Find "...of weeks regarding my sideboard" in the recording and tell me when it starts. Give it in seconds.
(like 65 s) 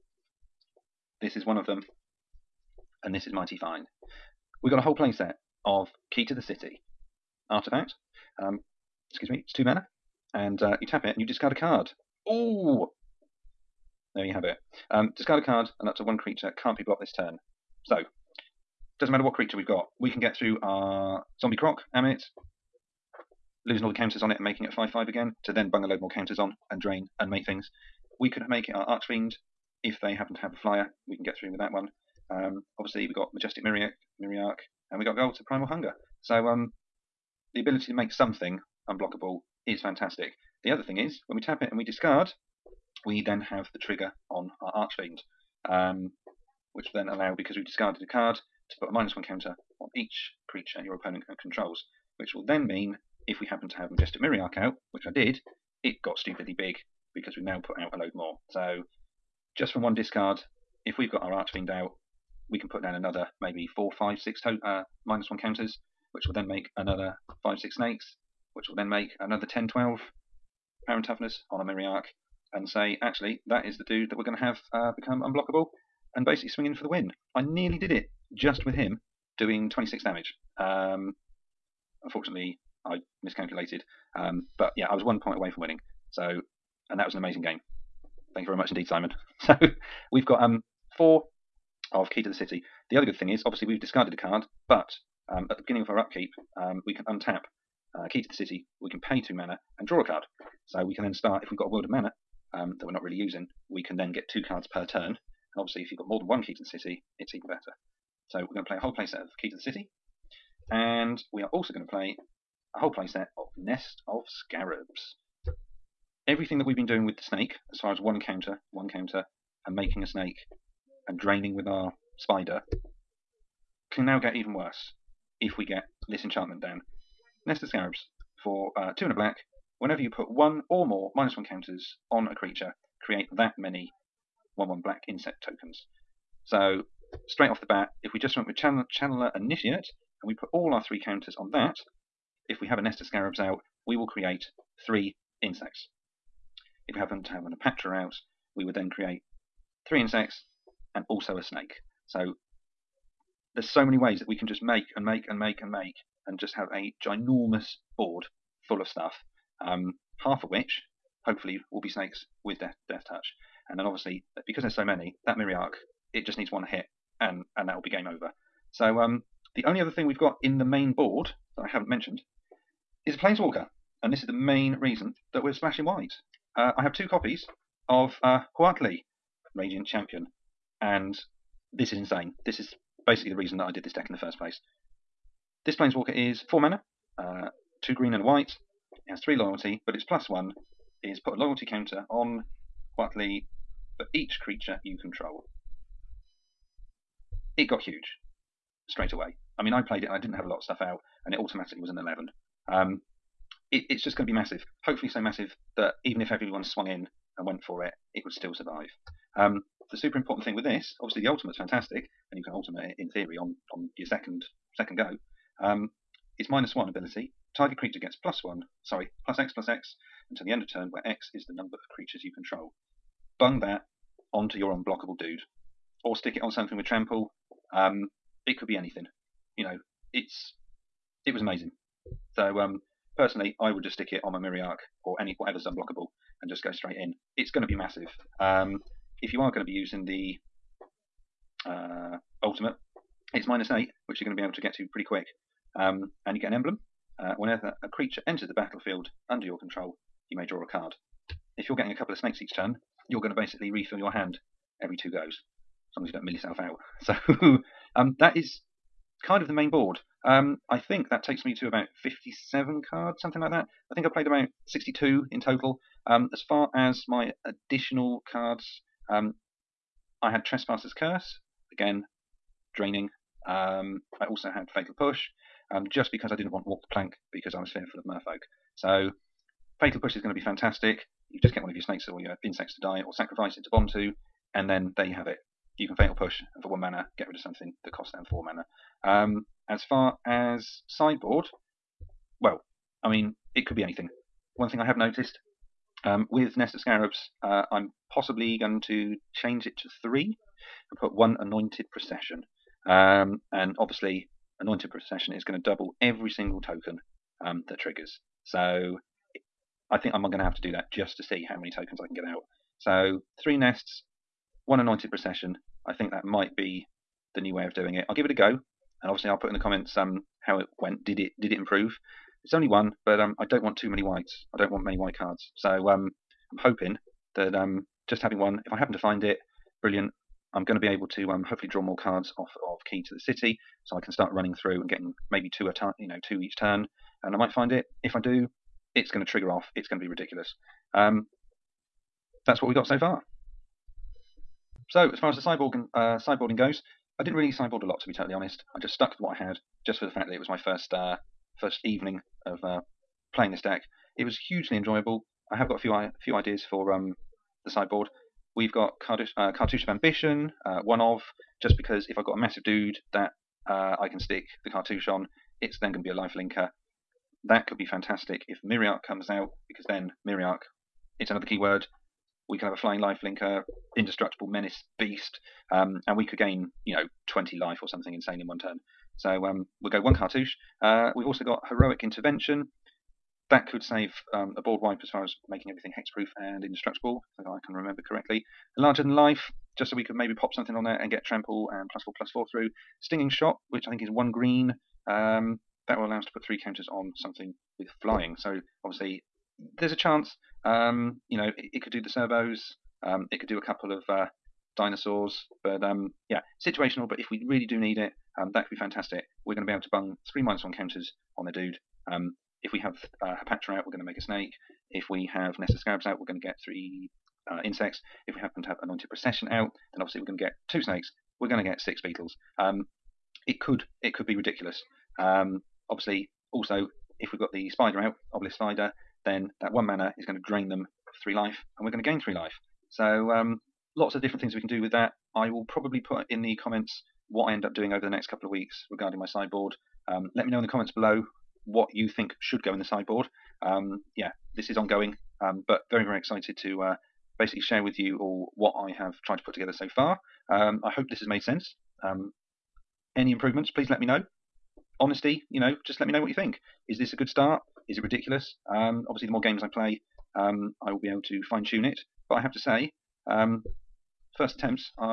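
438 s.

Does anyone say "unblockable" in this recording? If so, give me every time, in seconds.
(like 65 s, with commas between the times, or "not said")
38 s, 75 s, 224 s, 235 s.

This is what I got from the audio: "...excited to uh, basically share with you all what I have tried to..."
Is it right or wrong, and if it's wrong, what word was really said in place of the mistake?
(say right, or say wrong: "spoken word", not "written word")
right.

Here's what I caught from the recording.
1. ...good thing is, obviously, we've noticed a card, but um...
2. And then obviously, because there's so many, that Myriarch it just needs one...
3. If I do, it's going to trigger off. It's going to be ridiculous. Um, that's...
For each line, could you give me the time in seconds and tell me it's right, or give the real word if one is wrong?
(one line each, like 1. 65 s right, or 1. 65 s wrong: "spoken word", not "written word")
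1. 93 s wrong: "discarded", not "noticed"
2. 163 s right
3. 338 s right.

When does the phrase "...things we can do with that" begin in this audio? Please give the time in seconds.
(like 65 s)
434 s.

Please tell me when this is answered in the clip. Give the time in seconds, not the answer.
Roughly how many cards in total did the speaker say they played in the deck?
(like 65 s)
264 s.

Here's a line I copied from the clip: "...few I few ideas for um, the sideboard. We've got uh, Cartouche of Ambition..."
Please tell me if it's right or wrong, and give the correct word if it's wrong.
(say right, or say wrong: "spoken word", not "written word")
right.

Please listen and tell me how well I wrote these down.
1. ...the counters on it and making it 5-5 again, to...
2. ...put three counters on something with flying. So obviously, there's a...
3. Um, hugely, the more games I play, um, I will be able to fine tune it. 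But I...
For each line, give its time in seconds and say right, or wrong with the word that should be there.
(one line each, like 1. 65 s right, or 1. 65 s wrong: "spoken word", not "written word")
1. 23 s right
2. 396 s right
3. 458 s wrong: "obviously", not "hugely".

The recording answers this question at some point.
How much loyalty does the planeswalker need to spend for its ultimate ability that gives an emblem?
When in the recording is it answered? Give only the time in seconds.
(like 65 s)
243 s.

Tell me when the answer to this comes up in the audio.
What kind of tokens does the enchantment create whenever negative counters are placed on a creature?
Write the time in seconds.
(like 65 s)
134 s.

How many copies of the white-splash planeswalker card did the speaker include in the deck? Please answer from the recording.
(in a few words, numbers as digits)
2.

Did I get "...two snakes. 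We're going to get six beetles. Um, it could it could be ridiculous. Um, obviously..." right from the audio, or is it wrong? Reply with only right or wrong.
right.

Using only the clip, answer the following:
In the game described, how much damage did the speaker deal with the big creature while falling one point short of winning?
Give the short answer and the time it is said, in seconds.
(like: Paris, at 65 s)
26, at 79 s.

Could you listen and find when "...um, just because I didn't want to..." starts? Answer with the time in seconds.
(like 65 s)
275 s.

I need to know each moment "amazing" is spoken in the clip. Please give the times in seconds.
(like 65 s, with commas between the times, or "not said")
87 s, 231 s.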